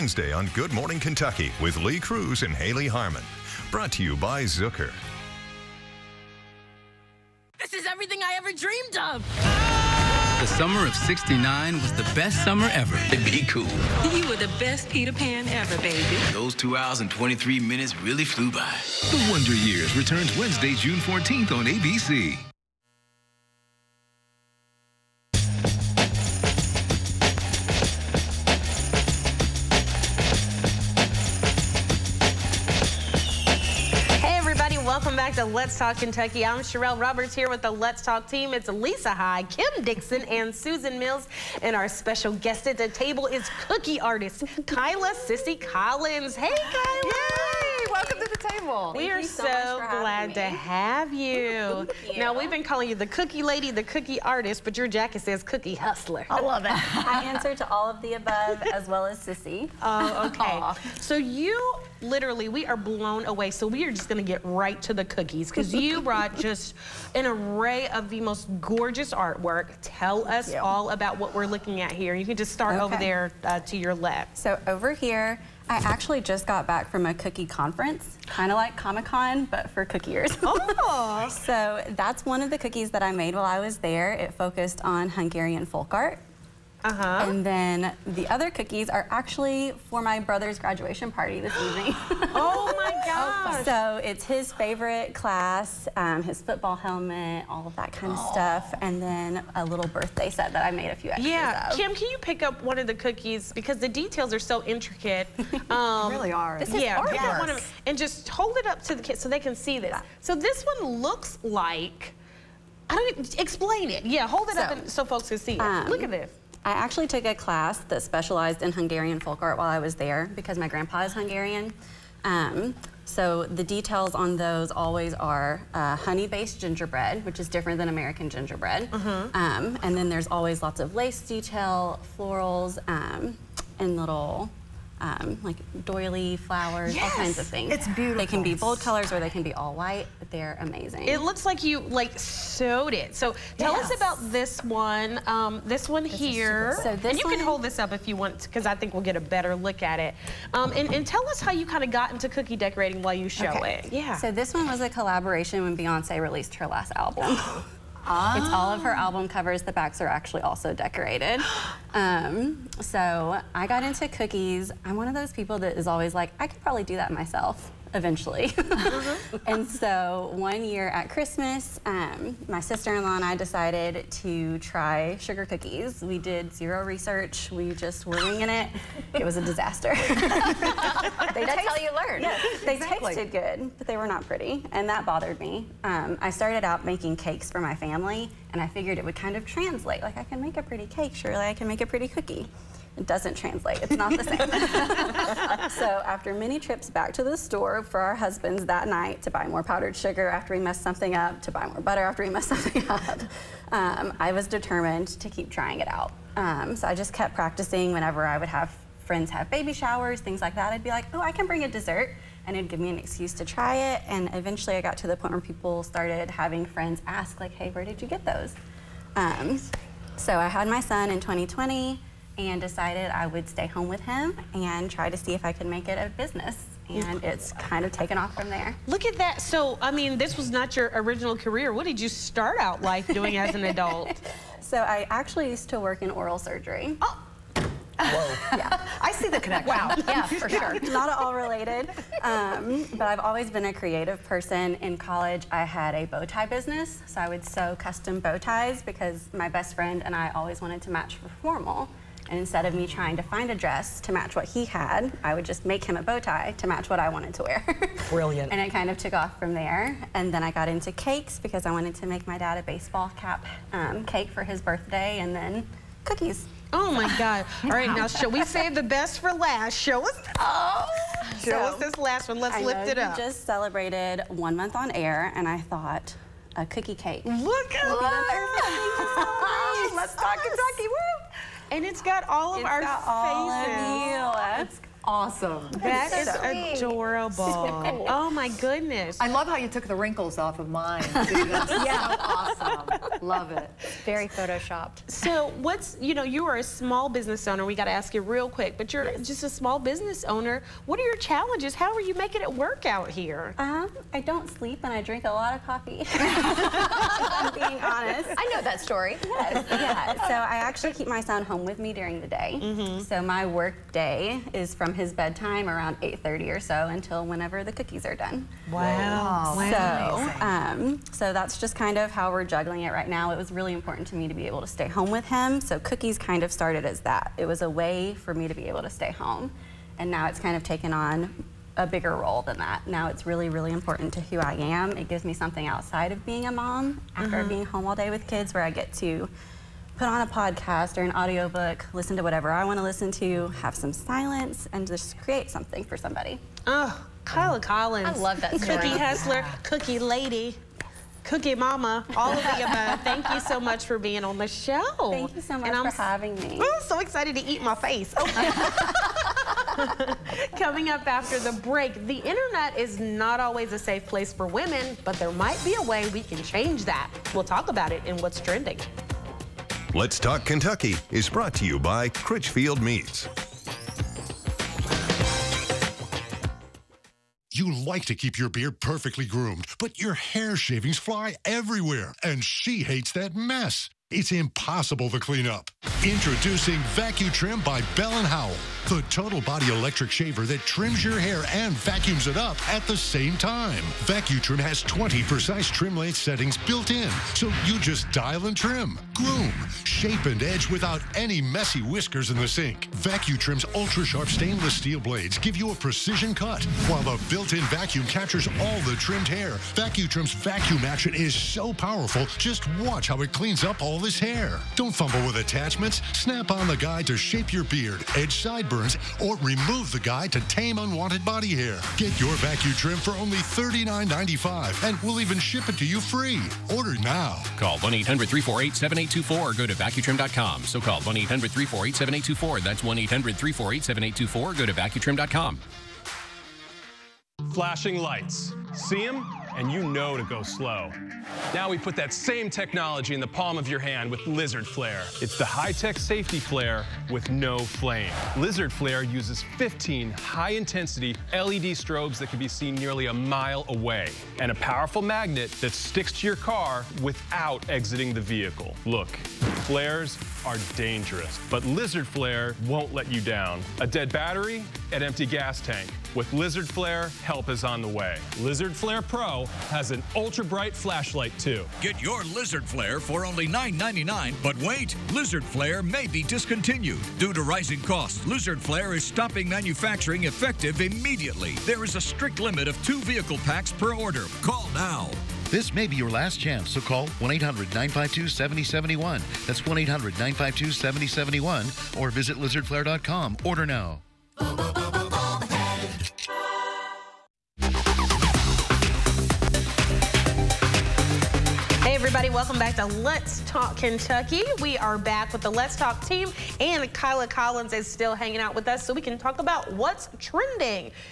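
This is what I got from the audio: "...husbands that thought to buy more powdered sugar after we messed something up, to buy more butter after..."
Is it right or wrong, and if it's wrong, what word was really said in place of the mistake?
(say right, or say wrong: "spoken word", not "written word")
wrong: "night", not "thought".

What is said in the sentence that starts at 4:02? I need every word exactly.
Um, but I've always been a creative person.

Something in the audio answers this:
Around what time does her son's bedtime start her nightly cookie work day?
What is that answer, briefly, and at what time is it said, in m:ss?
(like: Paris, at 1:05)
8:30, at 5:16.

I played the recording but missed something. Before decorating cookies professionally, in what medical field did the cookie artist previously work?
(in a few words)
Oral surgery.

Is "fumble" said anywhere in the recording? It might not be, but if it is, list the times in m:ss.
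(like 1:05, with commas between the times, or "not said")
6:54.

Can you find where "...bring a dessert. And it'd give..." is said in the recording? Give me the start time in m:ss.
3:31.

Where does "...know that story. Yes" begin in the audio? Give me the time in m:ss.
5:08.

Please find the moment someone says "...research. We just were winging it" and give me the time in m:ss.
2:56.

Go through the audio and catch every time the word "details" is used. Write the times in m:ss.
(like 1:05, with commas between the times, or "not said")
1:43, 2:03, 2:11.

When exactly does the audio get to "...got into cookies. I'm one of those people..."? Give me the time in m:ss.
2:43.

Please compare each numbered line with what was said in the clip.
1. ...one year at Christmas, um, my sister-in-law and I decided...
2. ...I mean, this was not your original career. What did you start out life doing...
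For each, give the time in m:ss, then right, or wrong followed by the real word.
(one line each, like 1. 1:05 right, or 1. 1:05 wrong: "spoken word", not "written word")
1. 2:50 right
2. 3:49 right.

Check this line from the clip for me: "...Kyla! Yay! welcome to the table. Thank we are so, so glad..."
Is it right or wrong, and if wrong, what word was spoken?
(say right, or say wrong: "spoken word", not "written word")
right.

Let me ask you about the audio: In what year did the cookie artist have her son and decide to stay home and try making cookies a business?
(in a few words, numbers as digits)
2020.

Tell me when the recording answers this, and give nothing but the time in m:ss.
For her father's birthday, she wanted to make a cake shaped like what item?
4:22.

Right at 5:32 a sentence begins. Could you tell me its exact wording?
Now it's really, really important to who I am.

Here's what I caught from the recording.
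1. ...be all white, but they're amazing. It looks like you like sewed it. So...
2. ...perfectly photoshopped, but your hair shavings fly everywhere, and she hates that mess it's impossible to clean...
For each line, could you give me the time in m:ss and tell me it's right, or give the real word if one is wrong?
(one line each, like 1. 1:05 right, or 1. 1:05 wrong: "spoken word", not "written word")
1. 2:19 right
2. 6:18 wrong: "groomed", not "photoshopped".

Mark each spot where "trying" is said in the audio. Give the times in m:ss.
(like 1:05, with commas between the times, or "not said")
3:25, 4:12.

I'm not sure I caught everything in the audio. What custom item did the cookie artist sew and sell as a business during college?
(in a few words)
Bow ties.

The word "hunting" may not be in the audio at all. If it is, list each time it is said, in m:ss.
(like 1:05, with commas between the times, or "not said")
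not said.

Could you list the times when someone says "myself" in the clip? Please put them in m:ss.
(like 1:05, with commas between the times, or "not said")
2:47.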